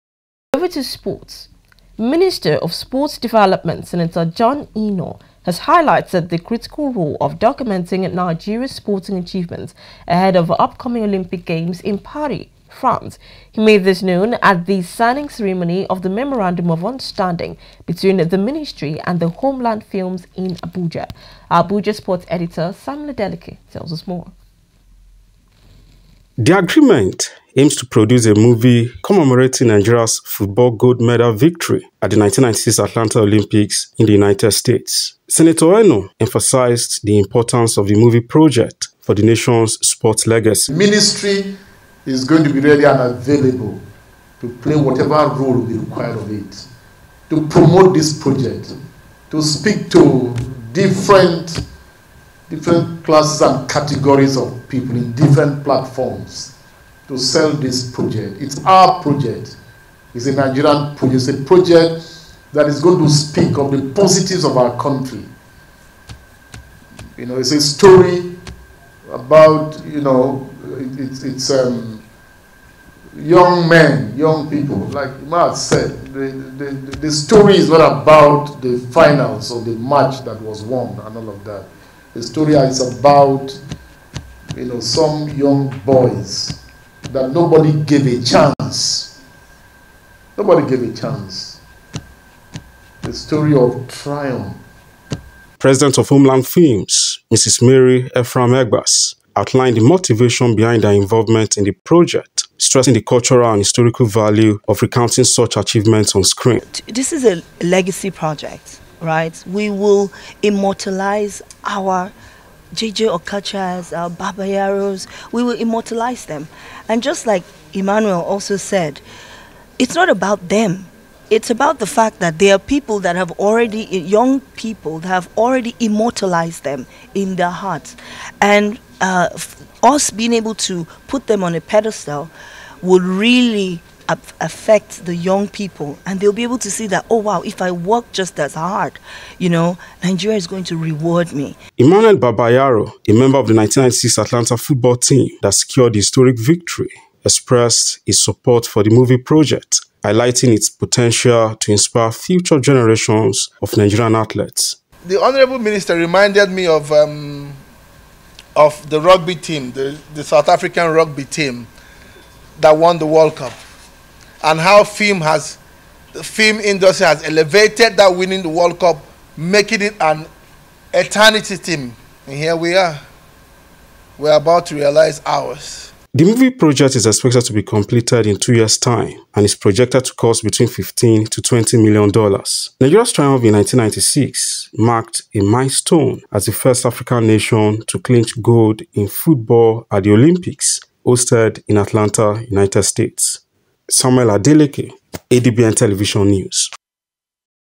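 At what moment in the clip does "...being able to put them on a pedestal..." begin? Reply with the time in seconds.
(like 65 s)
130 s.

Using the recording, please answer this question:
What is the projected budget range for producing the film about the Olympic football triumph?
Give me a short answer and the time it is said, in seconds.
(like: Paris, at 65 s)
15 to 20 million dollars, at 180 s.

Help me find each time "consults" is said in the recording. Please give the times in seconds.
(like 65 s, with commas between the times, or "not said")
not said.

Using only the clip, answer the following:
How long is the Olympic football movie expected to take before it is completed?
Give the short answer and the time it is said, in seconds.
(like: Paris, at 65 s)
2 years, at 178 s.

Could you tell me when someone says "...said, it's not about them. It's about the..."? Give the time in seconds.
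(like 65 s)
118 s.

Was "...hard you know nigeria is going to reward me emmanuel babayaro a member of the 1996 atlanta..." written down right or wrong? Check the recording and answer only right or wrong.
right.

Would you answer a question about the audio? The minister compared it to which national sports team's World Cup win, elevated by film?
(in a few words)
South African rugby team.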